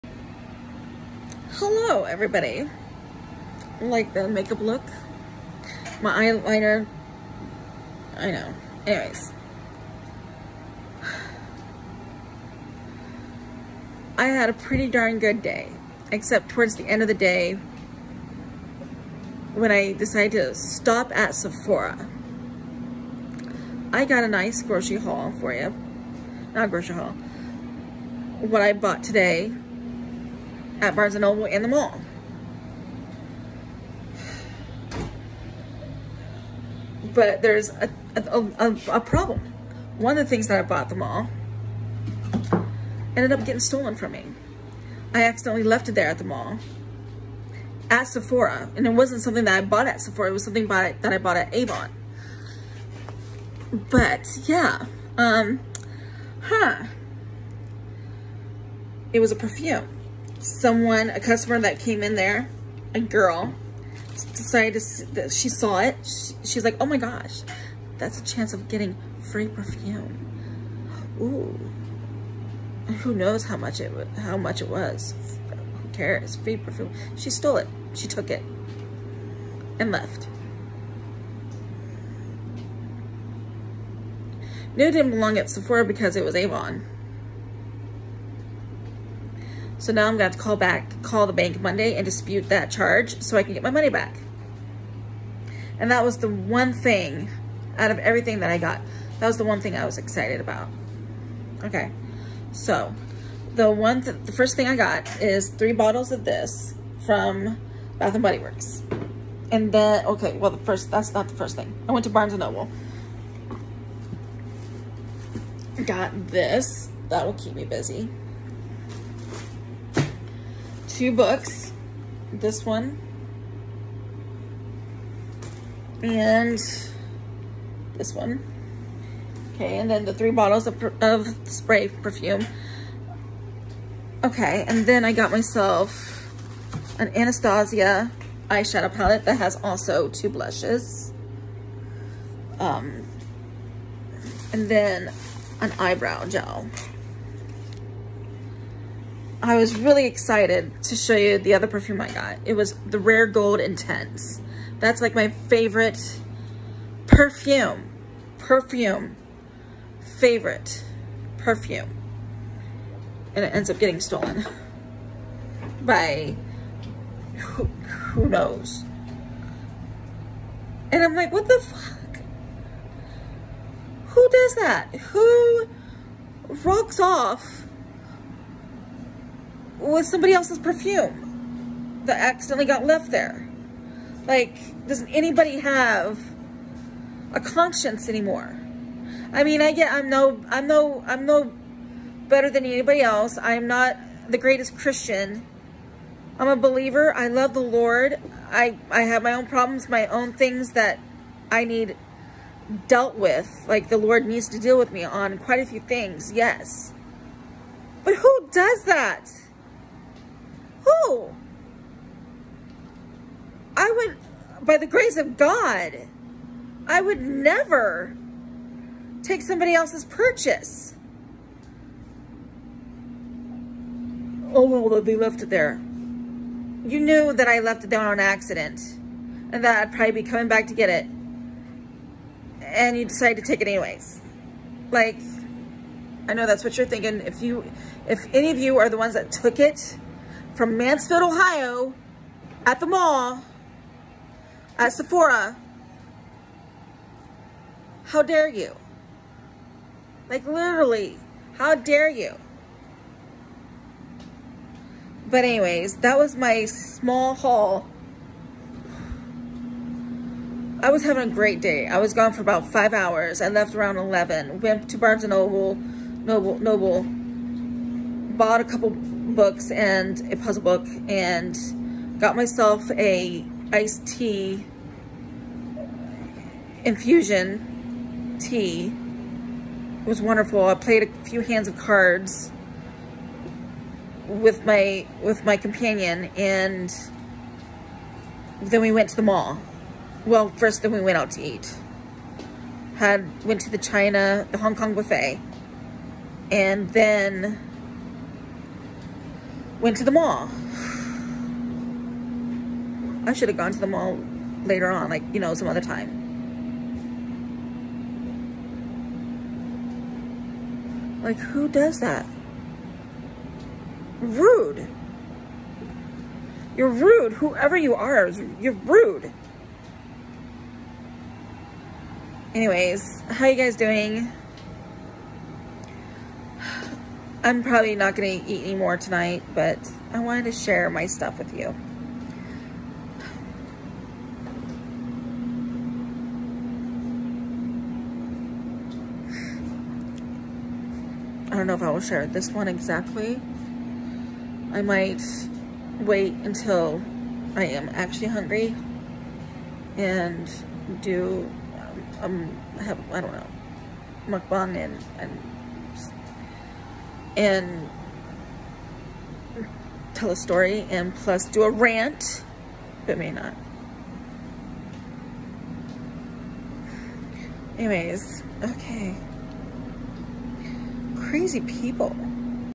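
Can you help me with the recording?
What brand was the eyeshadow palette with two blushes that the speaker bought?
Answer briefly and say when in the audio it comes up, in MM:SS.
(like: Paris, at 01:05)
Anastasia, at 02:17.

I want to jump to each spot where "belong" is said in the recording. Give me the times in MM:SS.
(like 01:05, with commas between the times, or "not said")
01:25.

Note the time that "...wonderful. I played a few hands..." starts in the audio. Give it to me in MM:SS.
04:40.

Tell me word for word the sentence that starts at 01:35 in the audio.
And that was the one thing out of everything that I got.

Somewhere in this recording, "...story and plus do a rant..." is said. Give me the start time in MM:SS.
06:00.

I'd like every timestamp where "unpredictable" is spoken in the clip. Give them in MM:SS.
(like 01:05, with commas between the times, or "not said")
not said.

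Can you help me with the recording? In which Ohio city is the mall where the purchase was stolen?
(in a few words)
Mansfield.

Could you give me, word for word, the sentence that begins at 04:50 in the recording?
Well, first then we went out to eat.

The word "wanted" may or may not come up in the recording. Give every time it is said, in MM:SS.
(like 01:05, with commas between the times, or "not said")
05:30.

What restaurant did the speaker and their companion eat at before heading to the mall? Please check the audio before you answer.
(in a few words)
Hong Kong buffet.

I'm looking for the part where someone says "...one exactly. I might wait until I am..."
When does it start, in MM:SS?
05:42.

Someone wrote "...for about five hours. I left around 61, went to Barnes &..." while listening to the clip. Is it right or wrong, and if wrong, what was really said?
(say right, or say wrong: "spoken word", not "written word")
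wrong: "11", not "61".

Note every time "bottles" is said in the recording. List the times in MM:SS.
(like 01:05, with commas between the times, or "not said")
01:45, 02:10.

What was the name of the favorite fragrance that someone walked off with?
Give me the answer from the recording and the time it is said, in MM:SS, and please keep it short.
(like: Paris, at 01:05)
Rare Gold Intense, at 02:32.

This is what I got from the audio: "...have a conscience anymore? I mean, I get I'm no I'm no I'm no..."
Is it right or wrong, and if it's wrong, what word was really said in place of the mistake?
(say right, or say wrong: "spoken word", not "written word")
right.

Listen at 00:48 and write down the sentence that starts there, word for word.
And it wasn't something that I bought at Sephora.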